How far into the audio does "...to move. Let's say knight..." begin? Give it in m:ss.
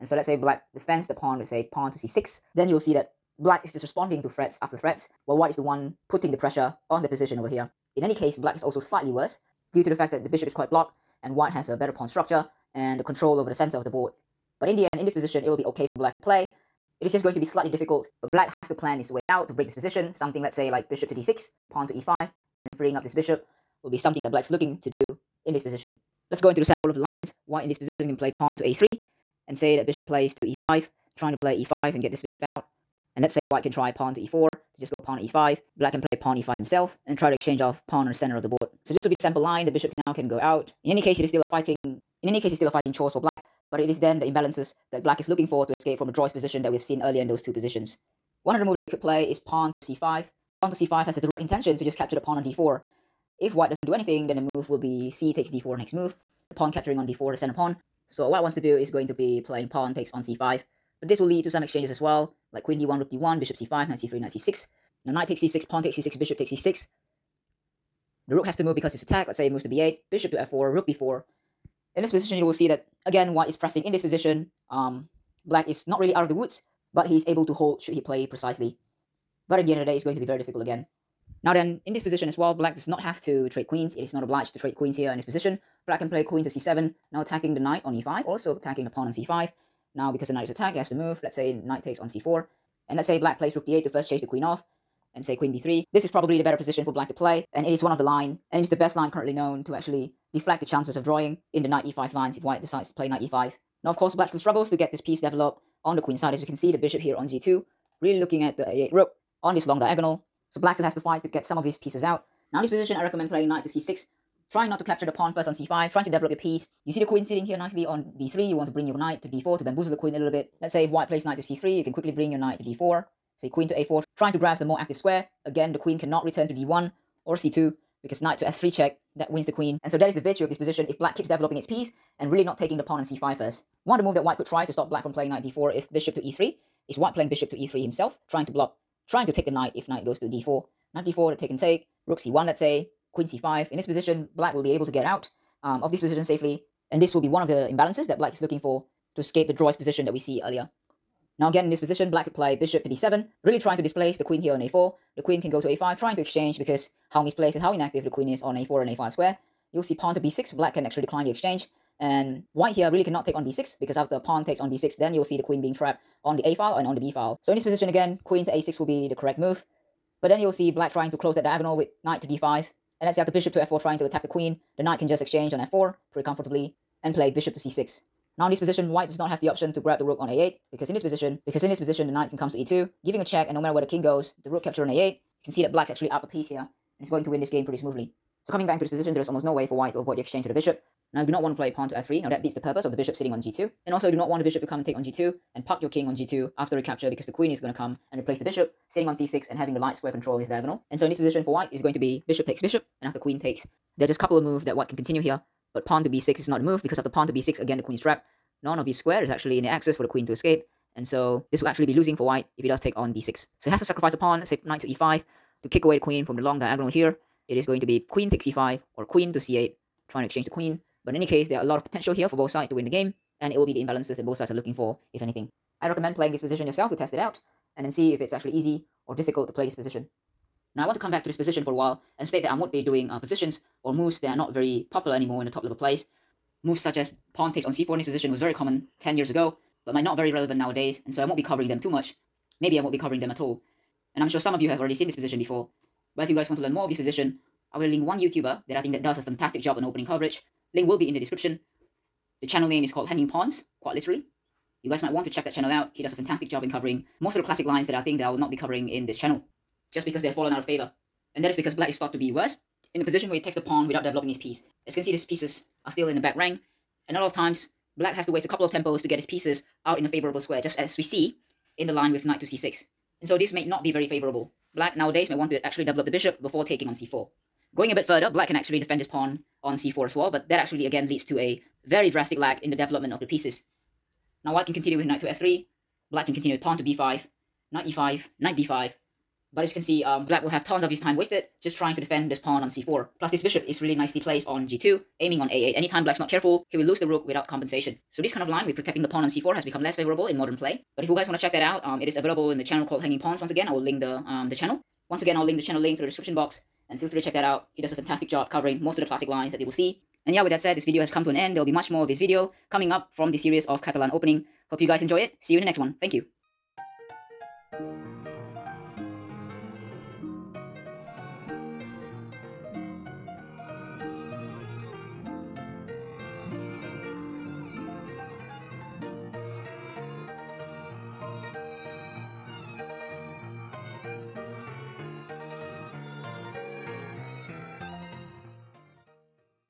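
1:30.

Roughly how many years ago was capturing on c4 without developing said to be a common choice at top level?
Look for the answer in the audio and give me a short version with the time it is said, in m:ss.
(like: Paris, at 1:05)
10, at 3:59.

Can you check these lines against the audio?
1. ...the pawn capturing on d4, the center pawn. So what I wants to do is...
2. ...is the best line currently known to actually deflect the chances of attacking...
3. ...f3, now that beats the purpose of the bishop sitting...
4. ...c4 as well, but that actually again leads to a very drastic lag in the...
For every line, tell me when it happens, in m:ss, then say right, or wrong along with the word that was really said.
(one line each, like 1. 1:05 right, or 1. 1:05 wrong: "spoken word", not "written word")
1. 0:56 right
2. 1:38 wrong: "drawing", not "attacking"
3. 3:11 right
4. 4:39 right.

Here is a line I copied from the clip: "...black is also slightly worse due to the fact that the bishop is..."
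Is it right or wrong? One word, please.
right.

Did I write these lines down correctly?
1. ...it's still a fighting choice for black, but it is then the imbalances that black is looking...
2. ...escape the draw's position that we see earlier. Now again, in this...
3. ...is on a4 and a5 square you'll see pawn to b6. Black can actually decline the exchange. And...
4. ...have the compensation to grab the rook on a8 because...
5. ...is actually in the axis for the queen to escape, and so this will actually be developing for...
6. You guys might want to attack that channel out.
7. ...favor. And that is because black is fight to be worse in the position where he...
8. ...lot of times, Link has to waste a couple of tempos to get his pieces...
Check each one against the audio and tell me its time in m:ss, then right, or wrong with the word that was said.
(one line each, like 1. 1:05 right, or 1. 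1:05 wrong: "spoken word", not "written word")
1. 0:42 right
2. 2:29 right
3. 2:38 right
4. 2:59 wrong: "option", not "compensation"
5. 3:29 wrong: "losing", not "developing"
6. 4:14 wrong: "check", not "attack"
7. 4:20 wrong: "thought", not "fight"
8. 4:27 wrong: "Black", not "Link".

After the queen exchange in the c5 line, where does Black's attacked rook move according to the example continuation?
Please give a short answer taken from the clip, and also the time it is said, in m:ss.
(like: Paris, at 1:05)
b8, at 1:09.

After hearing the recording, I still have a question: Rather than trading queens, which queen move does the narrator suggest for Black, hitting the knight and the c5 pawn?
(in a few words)
queen to c7.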